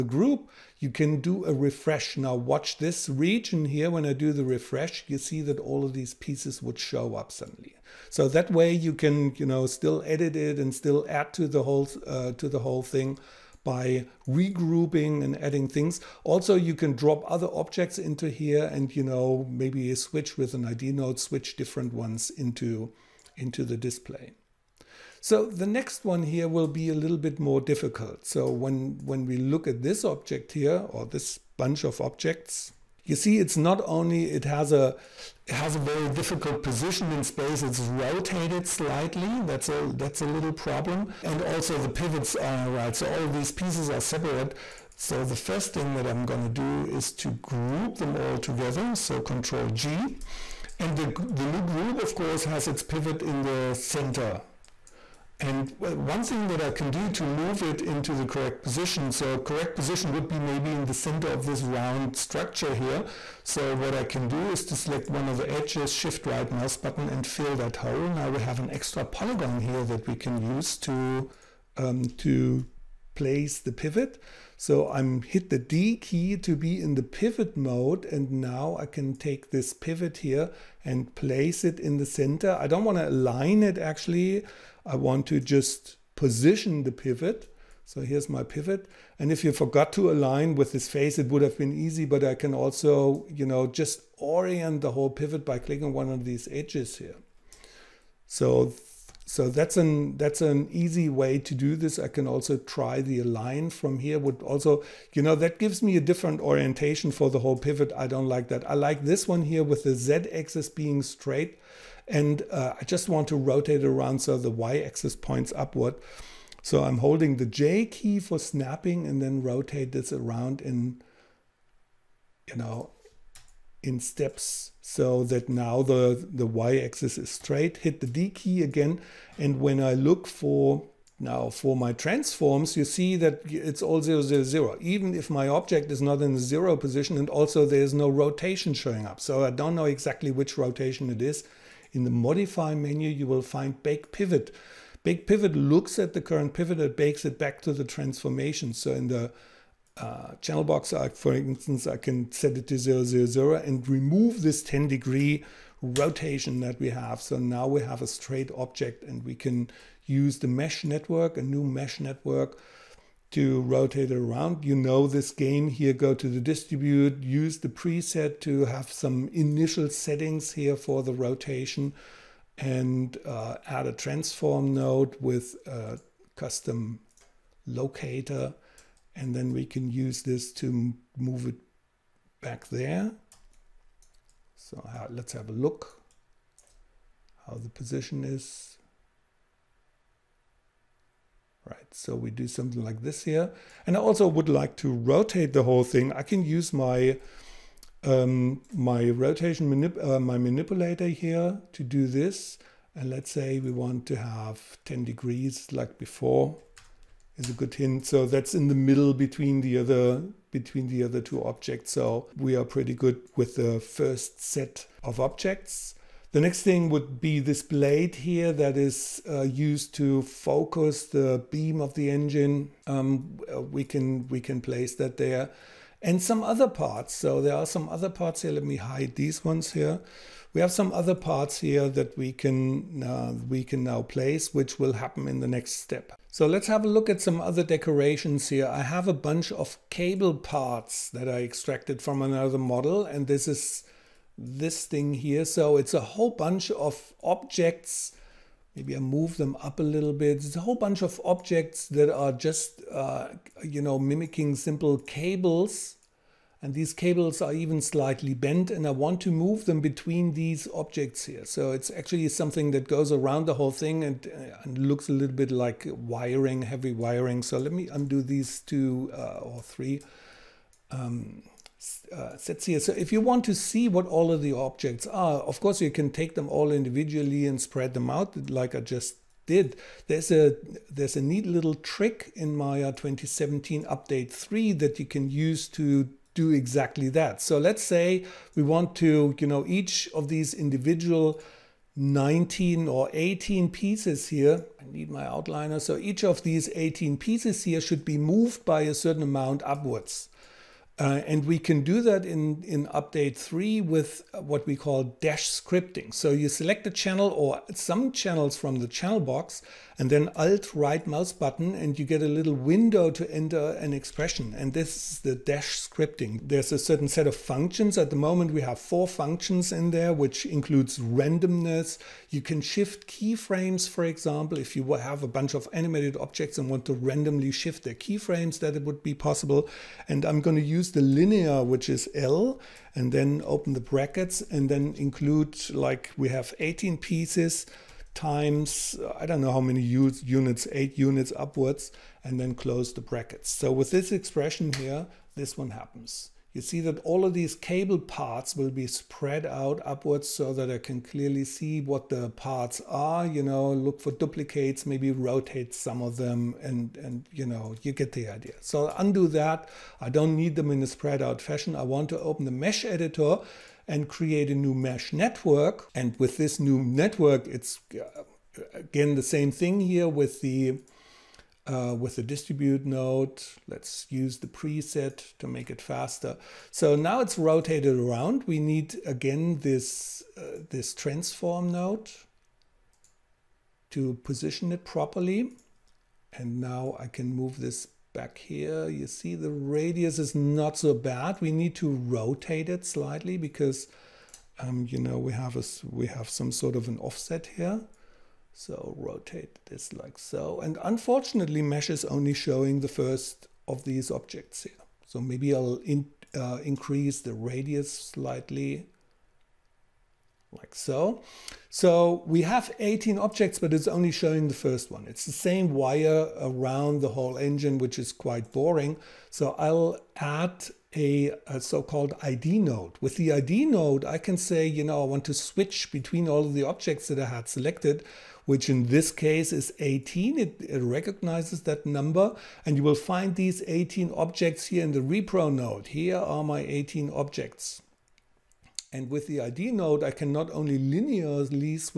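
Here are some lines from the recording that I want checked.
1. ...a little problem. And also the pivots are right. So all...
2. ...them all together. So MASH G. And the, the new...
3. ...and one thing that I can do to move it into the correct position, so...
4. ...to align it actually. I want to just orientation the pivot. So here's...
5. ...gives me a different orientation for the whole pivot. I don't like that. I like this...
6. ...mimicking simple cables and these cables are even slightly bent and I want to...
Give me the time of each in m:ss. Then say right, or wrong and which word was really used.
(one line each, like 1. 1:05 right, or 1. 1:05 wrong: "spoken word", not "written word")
1. 0:40 right
2. 0:47 wrong: "Control", not "MASH"
3. 0:55 right
4. 1:22 wrong: "position", not "orientation"
5. 1:45 right
6. 4:13 right.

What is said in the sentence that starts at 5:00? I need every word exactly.
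Uh, and we can do that in, in update three with what we call dash scripting.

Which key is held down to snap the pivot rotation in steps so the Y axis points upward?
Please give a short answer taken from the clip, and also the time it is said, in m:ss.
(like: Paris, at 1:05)
J, at 1:57.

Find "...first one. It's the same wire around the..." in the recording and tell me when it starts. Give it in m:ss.
6:54.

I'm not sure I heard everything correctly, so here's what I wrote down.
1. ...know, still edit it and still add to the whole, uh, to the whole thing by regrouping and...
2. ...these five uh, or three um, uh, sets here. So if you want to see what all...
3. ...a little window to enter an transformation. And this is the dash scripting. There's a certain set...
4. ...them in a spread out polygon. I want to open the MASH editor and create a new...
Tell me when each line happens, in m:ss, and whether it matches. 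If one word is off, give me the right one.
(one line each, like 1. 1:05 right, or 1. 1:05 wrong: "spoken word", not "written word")
1. 0:09 right
2. 4:28 wrong: "two", not "five"
3. 5:12 wrong: "expression", not "transformation"
4. 6:00 wrong: "fashion", not "polygon".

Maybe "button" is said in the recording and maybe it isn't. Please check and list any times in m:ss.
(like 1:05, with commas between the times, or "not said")
1:06, 5:11.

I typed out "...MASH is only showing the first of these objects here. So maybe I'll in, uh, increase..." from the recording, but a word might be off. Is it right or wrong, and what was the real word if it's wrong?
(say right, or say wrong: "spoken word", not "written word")
right.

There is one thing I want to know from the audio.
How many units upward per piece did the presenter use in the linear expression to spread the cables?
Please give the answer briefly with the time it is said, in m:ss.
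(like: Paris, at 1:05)
8, at 5:40.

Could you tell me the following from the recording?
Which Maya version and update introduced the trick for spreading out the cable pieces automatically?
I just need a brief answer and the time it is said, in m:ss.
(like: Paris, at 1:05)
Maya 2017 update 3, at 4:42.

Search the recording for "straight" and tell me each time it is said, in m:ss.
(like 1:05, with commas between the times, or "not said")
1:51, 2:07, 2:38.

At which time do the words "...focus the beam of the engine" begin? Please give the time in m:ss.
3:40.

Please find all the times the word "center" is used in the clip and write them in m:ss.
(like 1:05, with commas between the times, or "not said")
0:53, 1:00, 1:22.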